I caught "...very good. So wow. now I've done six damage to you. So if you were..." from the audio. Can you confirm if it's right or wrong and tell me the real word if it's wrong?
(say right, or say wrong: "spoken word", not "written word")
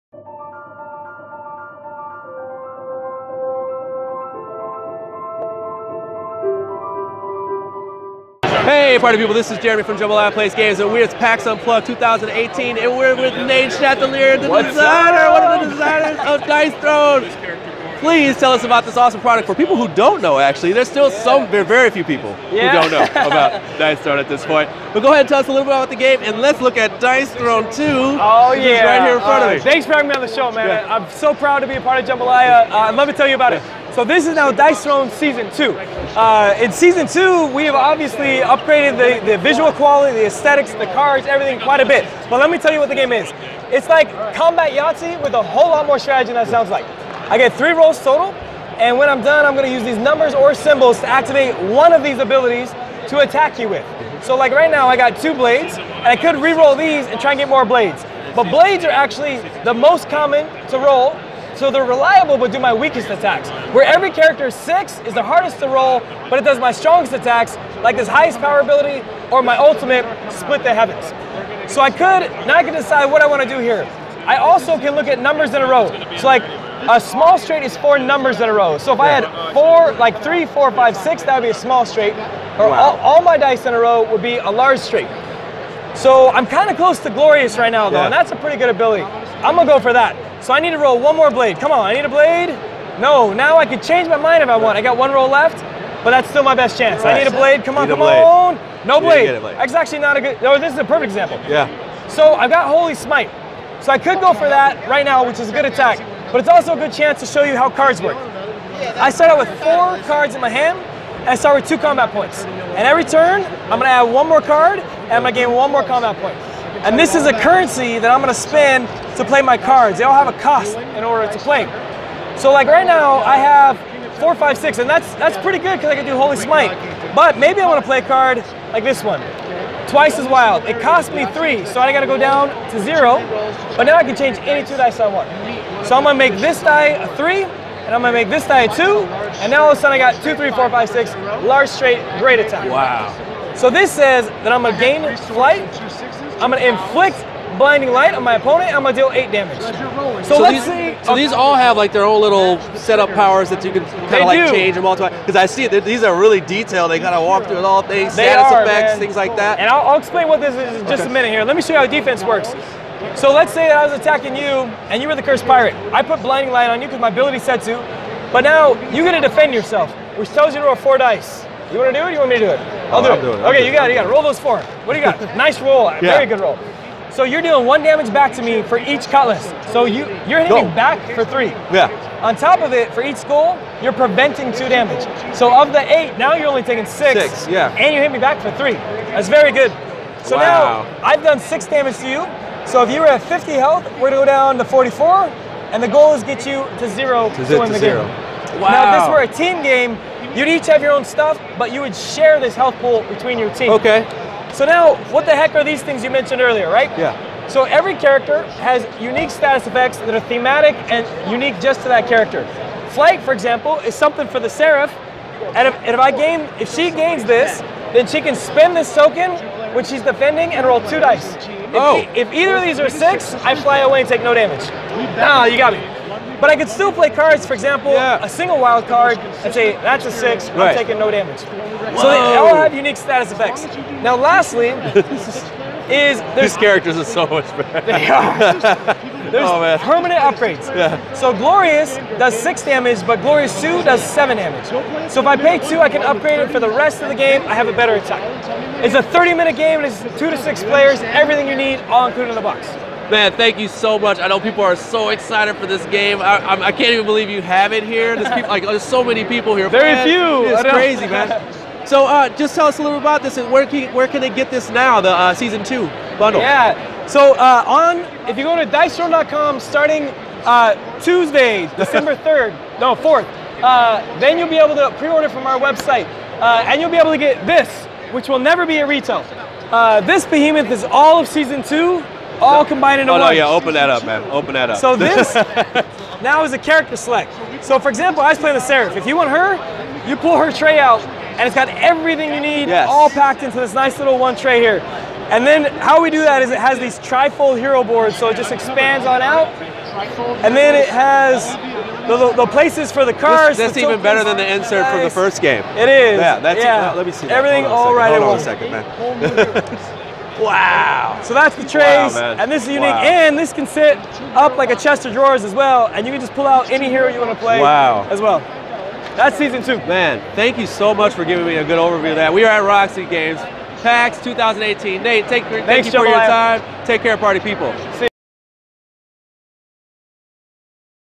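right.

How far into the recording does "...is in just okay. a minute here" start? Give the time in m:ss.
2:40.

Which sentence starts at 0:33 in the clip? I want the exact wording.
So this is now Dice Throne Season 2.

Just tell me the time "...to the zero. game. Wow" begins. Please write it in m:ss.
3:17.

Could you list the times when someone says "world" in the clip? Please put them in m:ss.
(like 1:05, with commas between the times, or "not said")
not said.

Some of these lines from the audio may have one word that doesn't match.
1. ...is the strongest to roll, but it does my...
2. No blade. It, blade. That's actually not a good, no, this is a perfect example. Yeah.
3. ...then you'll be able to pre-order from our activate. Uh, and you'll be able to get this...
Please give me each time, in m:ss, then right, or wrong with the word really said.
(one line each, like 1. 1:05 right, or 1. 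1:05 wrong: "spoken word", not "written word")
1. 1:05 wrong: "hardest", not "strongest"
2. 1:38 right
3. 4:34 wrong: "website", not "activate".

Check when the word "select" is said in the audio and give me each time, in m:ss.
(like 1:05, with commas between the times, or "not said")
4:46.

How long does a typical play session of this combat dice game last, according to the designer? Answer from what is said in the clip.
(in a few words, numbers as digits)
30 minutes.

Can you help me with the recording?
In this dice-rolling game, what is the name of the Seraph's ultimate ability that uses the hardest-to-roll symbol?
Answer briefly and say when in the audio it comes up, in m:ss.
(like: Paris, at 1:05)
Split the Heavens, at 1:10.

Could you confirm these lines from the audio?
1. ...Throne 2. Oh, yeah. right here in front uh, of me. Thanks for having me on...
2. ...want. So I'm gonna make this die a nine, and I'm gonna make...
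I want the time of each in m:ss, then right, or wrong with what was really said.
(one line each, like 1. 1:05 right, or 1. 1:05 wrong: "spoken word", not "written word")
1. 0:27 right
2. 2:15 wrong: "three", not "nine".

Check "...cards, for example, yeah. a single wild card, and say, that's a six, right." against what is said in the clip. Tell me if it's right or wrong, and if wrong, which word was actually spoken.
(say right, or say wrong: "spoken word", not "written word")
right.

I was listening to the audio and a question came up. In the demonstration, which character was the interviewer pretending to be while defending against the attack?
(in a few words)
the cursed pirate.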